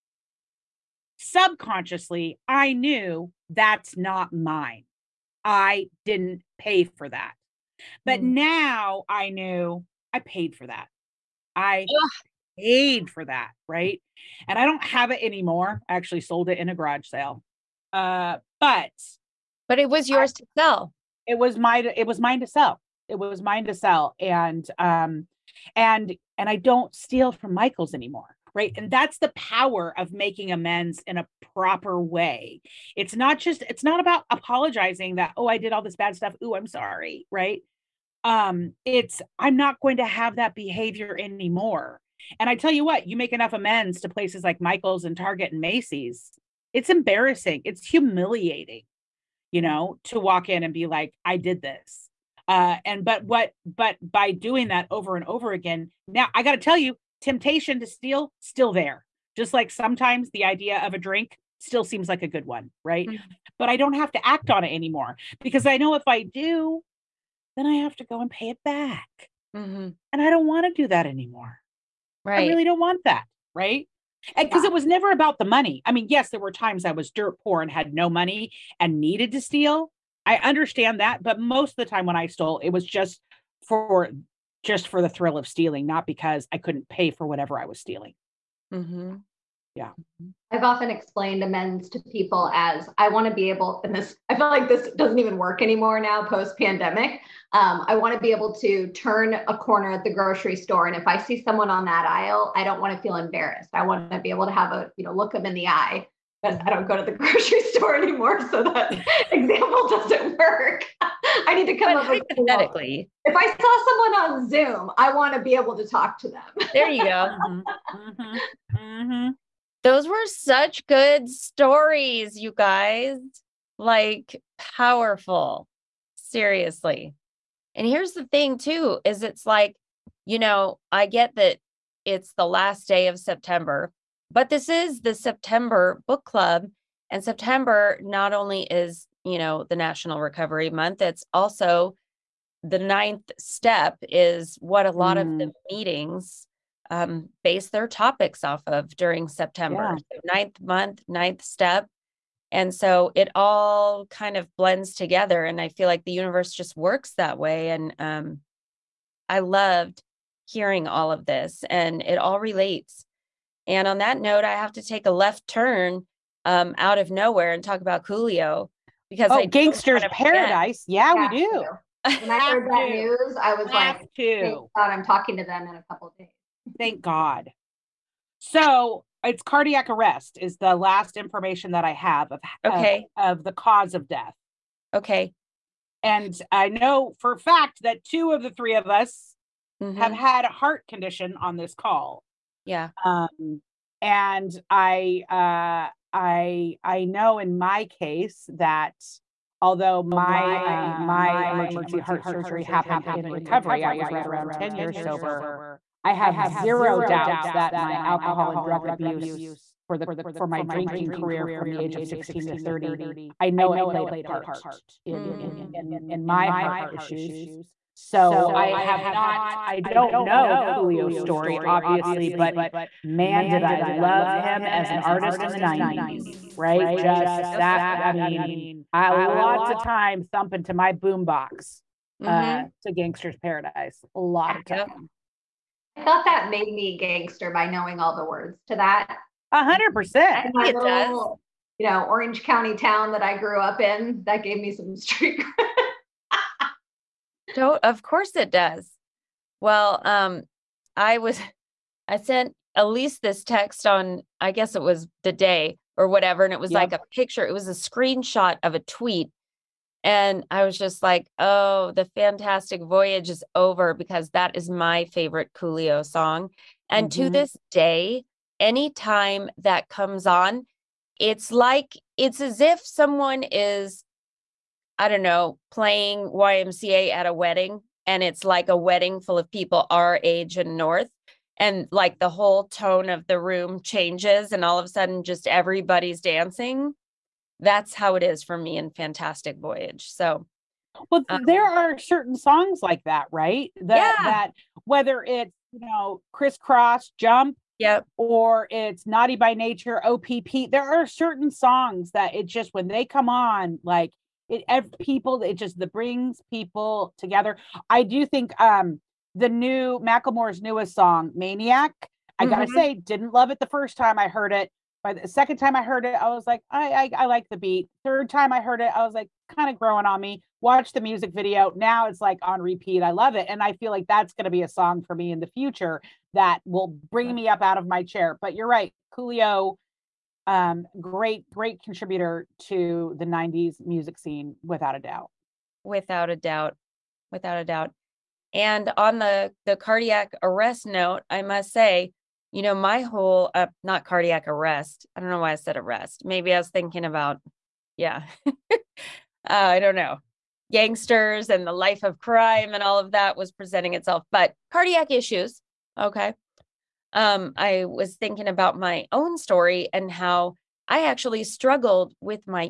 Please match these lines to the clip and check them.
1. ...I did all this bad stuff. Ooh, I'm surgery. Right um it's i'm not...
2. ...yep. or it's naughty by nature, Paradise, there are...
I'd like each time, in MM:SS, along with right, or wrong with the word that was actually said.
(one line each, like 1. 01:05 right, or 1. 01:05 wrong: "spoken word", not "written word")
1. 00:35 wrong: "sorry", not "surgery"
2. 04:57 wrong: "OPP", not "Paradise".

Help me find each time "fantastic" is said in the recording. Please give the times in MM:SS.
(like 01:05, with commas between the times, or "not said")
04:22, 04:48.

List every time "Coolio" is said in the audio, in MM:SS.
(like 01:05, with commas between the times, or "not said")
02:48, 03:40, 04:25, 05:29.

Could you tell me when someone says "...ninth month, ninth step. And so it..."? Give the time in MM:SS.
02:30.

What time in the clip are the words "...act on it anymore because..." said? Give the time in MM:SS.
01:04.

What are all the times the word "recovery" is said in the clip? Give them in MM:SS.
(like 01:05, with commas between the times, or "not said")
02:20, 03:23.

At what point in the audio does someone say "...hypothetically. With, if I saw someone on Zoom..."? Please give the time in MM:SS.
01:52.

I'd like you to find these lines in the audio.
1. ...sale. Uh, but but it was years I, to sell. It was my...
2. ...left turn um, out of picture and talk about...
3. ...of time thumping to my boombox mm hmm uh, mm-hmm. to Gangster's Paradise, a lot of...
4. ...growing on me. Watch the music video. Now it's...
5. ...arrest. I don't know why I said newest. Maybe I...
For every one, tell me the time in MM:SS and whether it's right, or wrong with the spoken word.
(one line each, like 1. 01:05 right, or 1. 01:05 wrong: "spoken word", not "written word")
1. 00:17 wrong: "yours", not "years"
2. 02:45 wrong: "nowhere", not "picture"
3. 03:49 right
4. 05:19 right
5. 05:44 wrong: "arrest", not "newest".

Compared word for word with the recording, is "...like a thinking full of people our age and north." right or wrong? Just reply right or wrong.
wrong.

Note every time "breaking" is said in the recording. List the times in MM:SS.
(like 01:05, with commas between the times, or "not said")
not said.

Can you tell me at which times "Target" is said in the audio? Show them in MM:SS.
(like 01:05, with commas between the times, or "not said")
00:45.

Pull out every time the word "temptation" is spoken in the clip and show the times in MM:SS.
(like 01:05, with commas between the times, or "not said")
00:57.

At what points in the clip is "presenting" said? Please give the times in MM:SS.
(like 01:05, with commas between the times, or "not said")
05:53.